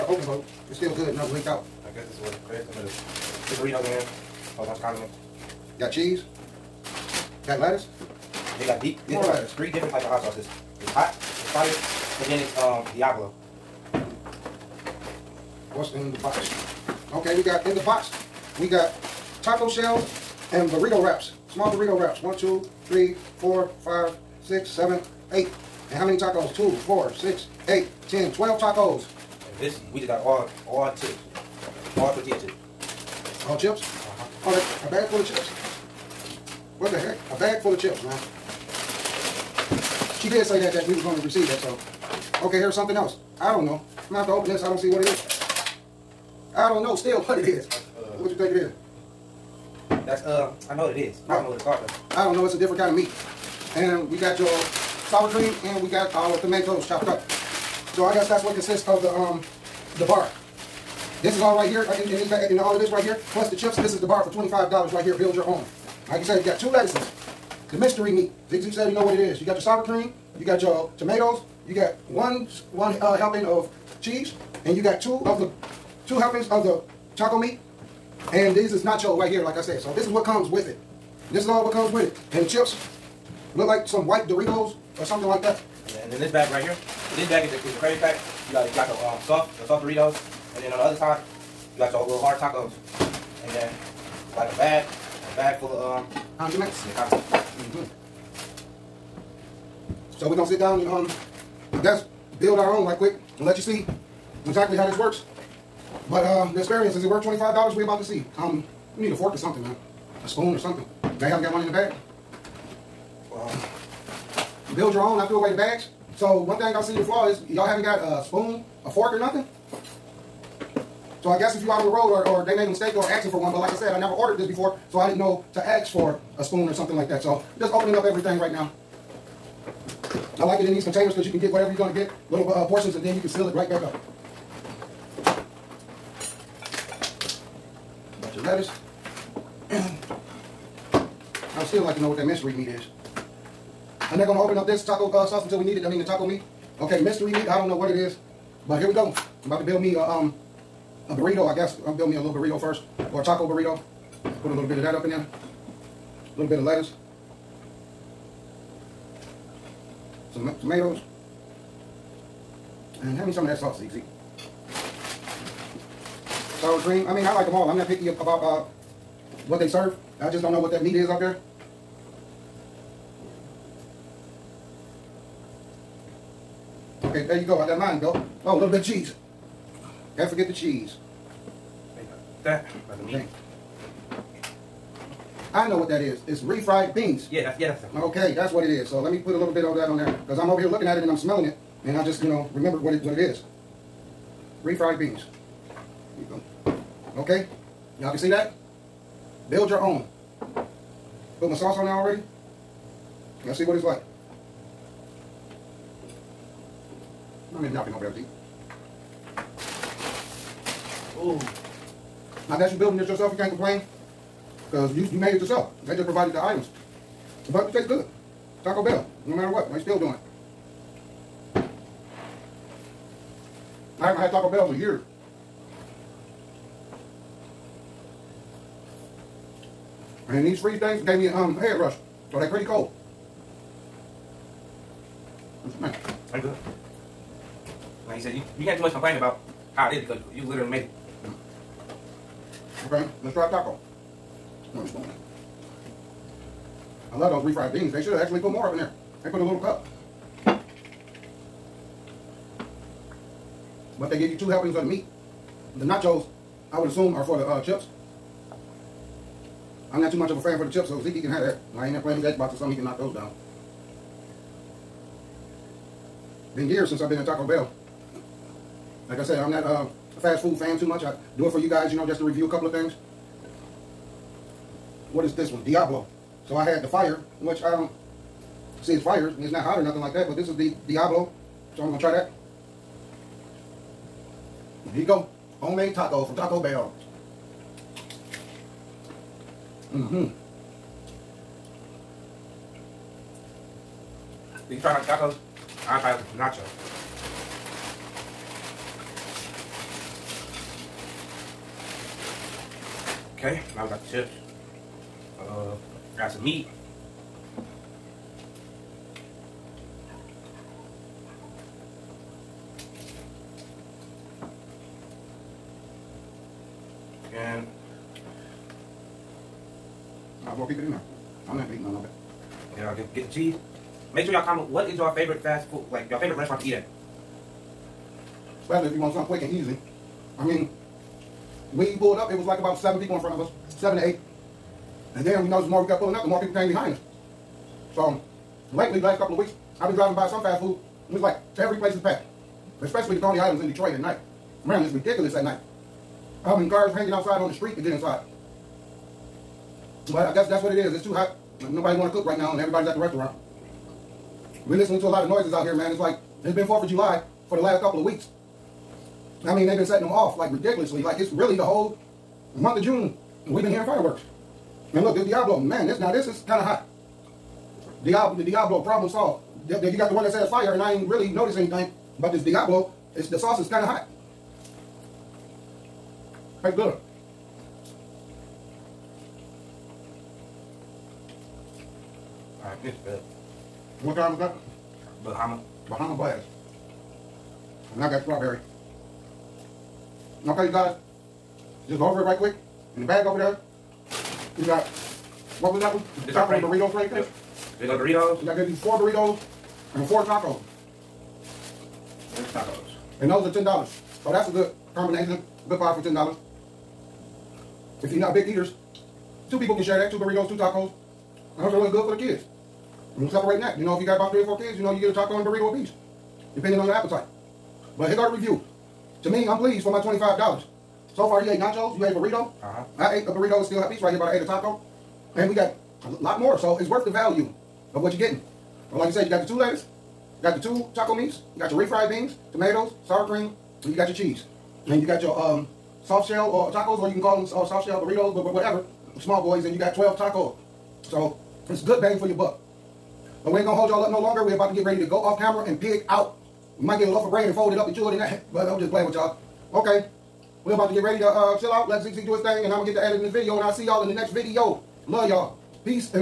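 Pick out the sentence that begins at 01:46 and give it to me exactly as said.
But uh, the experience, is it worth $25?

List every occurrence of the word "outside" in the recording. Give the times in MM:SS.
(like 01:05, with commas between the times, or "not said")
05:47.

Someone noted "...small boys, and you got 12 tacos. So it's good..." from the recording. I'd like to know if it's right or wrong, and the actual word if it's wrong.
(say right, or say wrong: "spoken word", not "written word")
right.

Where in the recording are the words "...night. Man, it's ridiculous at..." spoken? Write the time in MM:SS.
05:43.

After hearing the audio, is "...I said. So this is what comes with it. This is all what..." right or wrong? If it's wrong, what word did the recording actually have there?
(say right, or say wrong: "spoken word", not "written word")
right.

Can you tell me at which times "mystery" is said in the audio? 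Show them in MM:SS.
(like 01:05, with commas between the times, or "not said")
01:07, 02:22, 02:27.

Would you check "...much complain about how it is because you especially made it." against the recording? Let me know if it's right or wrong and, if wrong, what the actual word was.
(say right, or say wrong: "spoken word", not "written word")
wrong: "literally", not "especially".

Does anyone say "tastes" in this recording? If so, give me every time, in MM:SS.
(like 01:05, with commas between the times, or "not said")
03:37, 06:16.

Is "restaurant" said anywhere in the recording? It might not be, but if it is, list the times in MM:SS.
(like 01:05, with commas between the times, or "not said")
05:26, 05:52.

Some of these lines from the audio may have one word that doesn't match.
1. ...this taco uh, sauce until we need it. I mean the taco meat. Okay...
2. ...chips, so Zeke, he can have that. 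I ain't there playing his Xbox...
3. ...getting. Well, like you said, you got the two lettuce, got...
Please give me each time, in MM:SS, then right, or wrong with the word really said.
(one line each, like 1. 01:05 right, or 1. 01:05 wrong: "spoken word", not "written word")
1. 02:24 right
2. 04:20 right
3. 07:08 right.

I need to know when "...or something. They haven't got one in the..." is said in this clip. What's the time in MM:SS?
01:50.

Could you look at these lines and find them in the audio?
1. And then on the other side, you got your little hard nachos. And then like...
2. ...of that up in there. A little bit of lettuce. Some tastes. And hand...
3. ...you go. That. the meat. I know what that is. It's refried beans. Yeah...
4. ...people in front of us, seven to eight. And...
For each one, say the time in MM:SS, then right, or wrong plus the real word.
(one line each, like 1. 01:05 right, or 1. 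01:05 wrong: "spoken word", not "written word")
1. 01:30 wrong: "tacos", not "nachos"
2. 02:34 wrong: "tomatoes", not "tastes"
3. 03:02 right
4. 05:32 right.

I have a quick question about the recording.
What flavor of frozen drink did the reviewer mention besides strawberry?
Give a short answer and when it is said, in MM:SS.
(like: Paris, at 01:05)
Bahama Blast, at 06:25.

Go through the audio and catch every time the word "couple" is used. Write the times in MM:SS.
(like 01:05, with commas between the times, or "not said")
04:32, 05:39, 05:57.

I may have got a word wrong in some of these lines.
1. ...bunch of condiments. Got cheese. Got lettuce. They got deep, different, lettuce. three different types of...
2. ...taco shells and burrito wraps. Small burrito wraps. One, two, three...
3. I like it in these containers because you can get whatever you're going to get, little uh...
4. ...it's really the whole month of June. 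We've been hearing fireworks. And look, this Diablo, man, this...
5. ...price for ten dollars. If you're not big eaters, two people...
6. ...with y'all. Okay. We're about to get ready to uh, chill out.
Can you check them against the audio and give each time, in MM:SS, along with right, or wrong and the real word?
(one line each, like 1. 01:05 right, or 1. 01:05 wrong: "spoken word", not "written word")
1. 00:04 right
2. 00:19 right
3. 02:10 right
4. 06:01 right
5. 06:45 right
6. 07:29 right.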